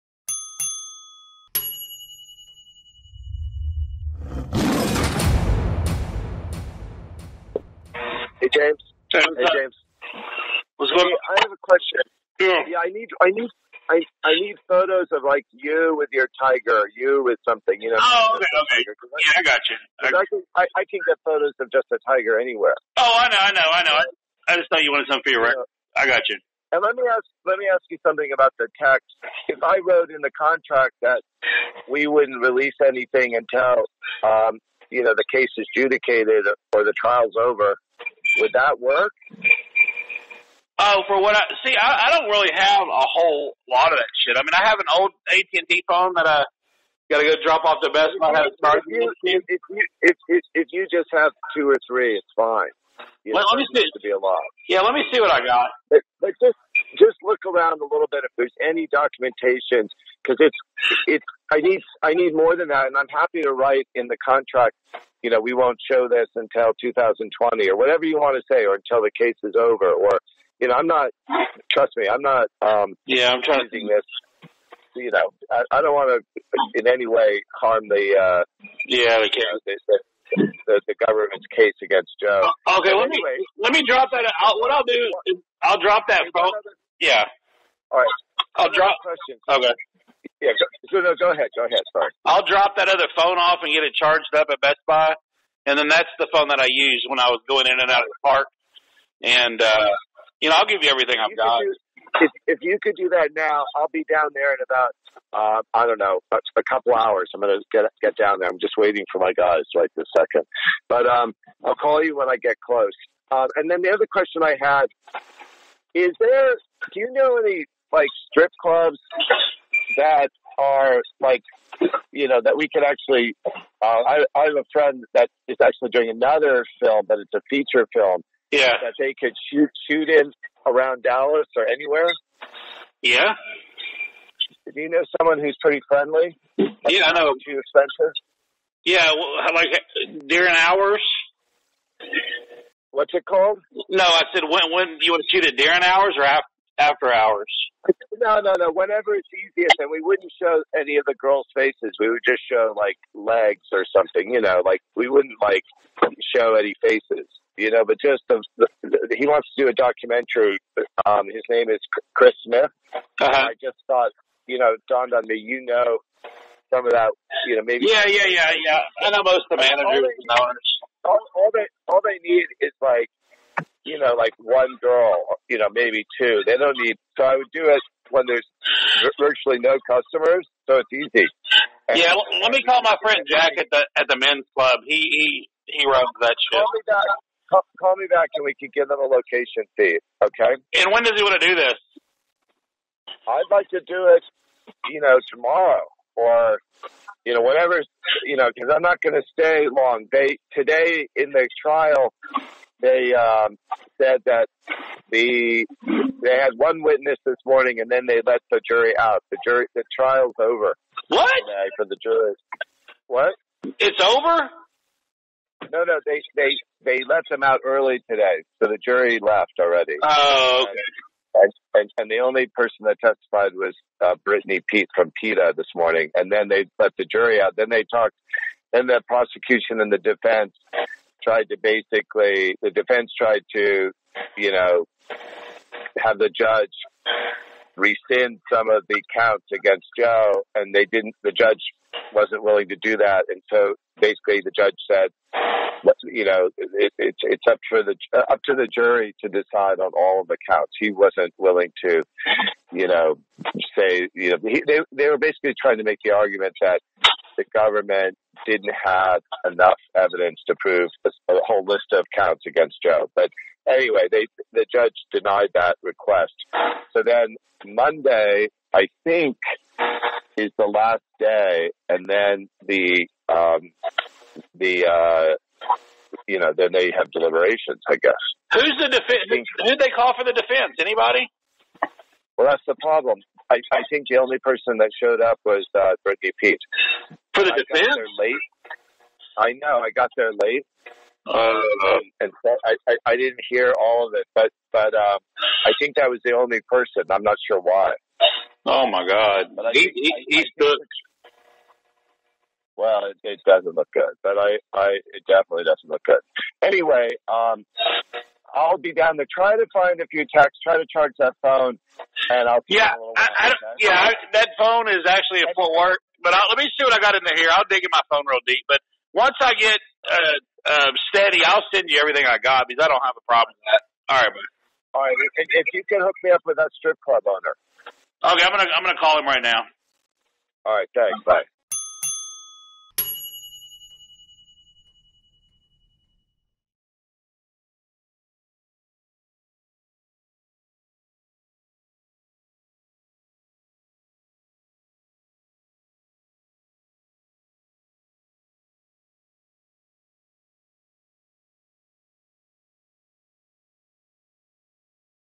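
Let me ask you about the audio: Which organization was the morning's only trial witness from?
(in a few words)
PETA.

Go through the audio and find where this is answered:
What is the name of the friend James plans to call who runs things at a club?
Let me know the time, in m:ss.
3:03.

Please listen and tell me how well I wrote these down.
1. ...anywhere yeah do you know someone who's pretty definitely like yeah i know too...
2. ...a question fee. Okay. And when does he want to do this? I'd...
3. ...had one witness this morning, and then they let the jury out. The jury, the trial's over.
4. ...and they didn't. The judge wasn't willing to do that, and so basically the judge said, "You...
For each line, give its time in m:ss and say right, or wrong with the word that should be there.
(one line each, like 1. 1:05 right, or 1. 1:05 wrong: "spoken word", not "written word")
1. 2:11 wrong: "friendly", not "definitely"
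2. 3:08 wrong: "location", not "question"
3. 3:26 right
4. 4:00 right.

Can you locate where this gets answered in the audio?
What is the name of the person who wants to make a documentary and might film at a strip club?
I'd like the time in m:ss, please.
2:42.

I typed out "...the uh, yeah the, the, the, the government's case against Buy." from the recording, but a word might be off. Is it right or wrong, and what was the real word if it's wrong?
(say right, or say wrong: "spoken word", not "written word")
wrong: "Joe", not "Buy".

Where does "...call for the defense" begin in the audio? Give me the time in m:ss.
4:39.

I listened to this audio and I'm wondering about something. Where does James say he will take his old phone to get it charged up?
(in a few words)
Best Buy.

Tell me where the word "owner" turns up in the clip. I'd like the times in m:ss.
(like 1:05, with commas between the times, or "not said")
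5:27.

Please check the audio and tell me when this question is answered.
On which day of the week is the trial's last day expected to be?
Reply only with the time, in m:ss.
4:27.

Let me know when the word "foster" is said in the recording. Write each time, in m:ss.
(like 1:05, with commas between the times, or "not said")
not said.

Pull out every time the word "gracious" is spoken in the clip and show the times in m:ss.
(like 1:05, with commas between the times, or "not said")
not said.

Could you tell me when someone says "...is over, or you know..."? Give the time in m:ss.
1:09.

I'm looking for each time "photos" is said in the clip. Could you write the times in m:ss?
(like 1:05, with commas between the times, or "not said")
0:14, 0:21.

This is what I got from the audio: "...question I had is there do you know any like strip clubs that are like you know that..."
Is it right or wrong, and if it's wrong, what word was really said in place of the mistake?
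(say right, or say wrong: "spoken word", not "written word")
right.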